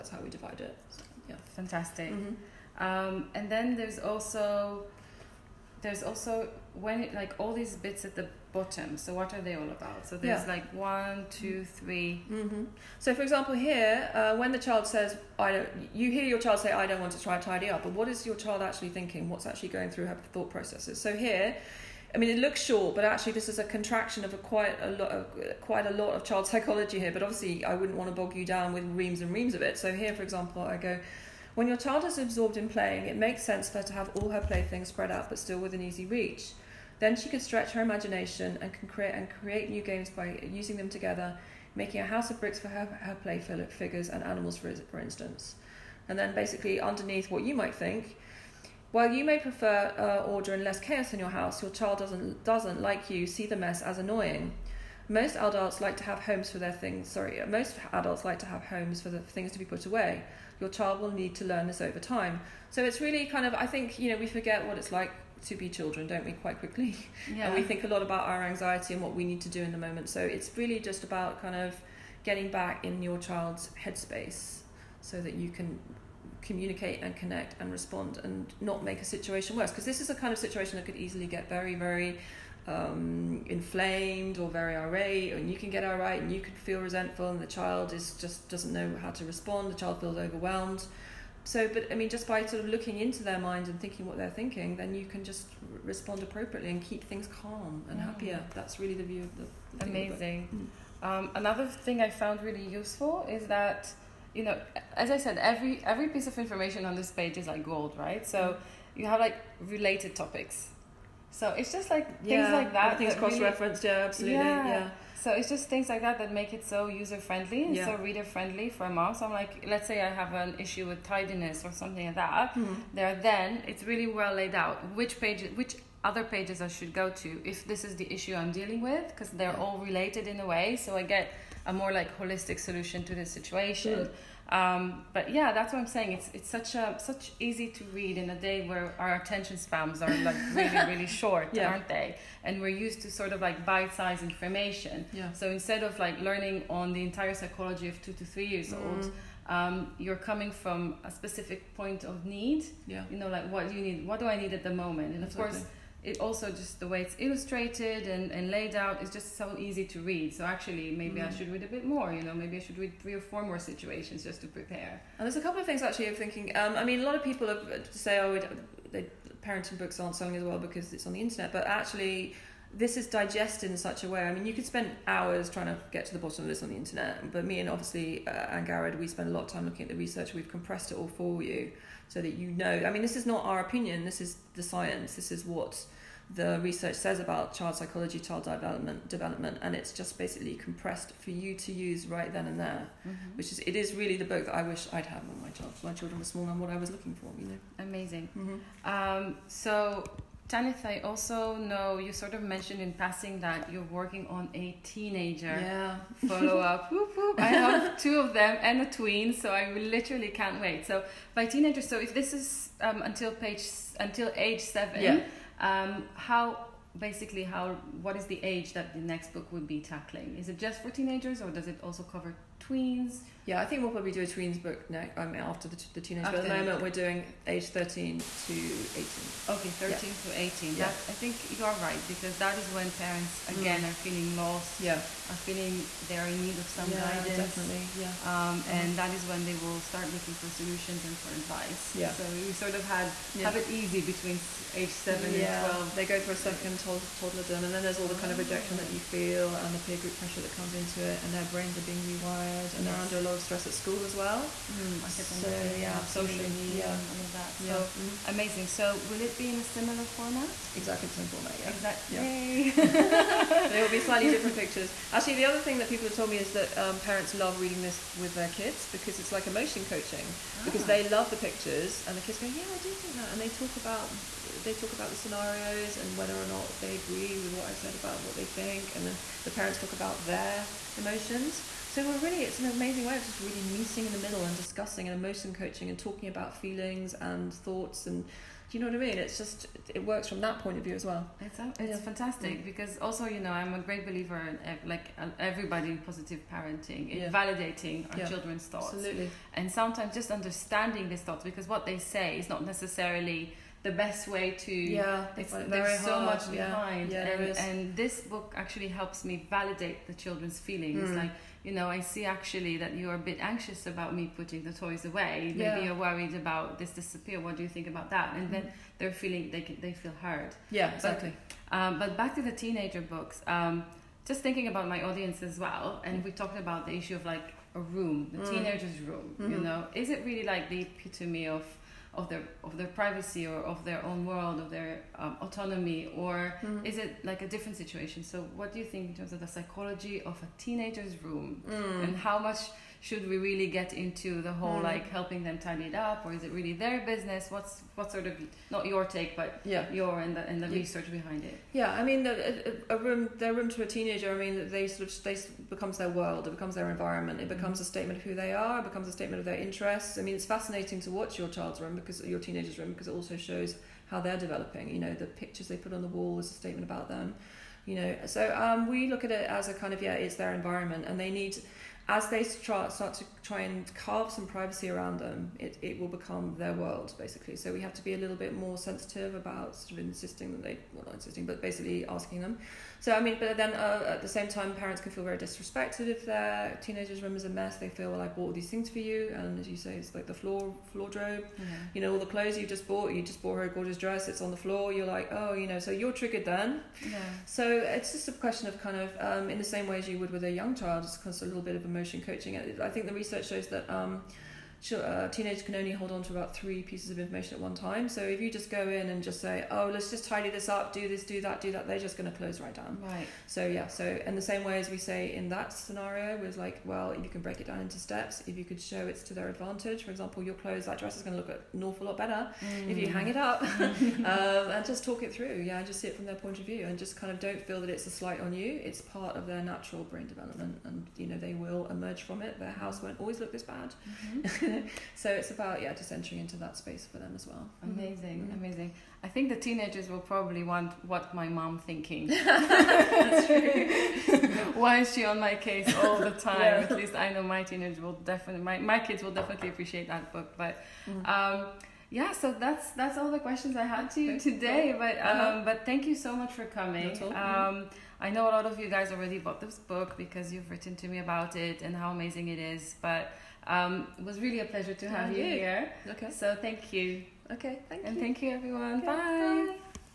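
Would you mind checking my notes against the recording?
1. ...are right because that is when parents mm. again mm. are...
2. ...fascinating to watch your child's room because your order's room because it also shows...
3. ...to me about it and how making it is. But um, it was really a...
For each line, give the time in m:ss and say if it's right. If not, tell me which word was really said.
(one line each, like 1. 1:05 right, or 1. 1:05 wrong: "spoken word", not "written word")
1. 3:51 right
2. 6:00 wrong: "teenager", not "order"
3. 7:40 wrong: "amazing", not "making".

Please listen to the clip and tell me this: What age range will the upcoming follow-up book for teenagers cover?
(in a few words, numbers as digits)
13 to 18.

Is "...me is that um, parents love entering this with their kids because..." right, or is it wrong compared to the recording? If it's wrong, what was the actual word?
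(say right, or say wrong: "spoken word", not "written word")
wrong: "reading", not "entering".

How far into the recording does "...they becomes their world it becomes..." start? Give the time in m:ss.
5:55.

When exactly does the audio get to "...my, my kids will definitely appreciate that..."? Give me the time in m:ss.
7:28.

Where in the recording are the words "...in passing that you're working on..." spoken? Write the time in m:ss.
3:22.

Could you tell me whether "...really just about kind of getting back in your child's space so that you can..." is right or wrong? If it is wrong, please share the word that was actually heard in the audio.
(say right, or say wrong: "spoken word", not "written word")
wrong: "headspace", not "space".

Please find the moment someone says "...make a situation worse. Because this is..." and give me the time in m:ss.
1:18.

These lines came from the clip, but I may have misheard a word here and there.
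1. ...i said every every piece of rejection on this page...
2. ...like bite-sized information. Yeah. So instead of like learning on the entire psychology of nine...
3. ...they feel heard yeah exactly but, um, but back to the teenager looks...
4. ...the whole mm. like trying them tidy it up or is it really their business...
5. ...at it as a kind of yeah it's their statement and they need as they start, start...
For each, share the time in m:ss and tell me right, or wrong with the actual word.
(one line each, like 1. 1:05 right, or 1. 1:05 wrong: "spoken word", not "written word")
1. 1:45 wrong: "information", not "rejection"
2. 2:23 wrong: "two", not "nine"
3. 5:19 wrong: "books", not "looks"
4. 5:44 wrong: "helping", not "trying"
5. 6:09 wrong: "environment", not "statement".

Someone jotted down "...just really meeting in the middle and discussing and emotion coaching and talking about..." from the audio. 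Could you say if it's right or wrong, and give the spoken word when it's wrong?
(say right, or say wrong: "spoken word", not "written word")
right.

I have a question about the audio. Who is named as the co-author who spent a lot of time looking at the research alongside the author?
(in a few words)
Angharad.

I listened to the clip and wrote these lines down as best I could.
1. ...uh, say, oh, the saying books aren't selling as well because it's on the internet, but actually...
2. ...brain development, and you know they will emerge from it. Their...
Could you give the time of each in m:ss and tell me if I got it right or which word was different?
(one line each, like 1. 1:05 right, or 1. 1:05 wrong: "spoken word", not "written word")
1. 2:47 wrong: "parenting", not "saying"
2. 7:10 right.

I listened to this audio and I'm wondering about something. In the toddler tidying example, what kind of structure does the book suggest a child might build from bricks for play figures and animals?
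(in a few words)
a house.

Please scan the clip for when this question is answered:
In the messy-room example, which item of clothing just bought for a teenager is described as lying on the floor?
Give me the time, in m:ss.
6:33.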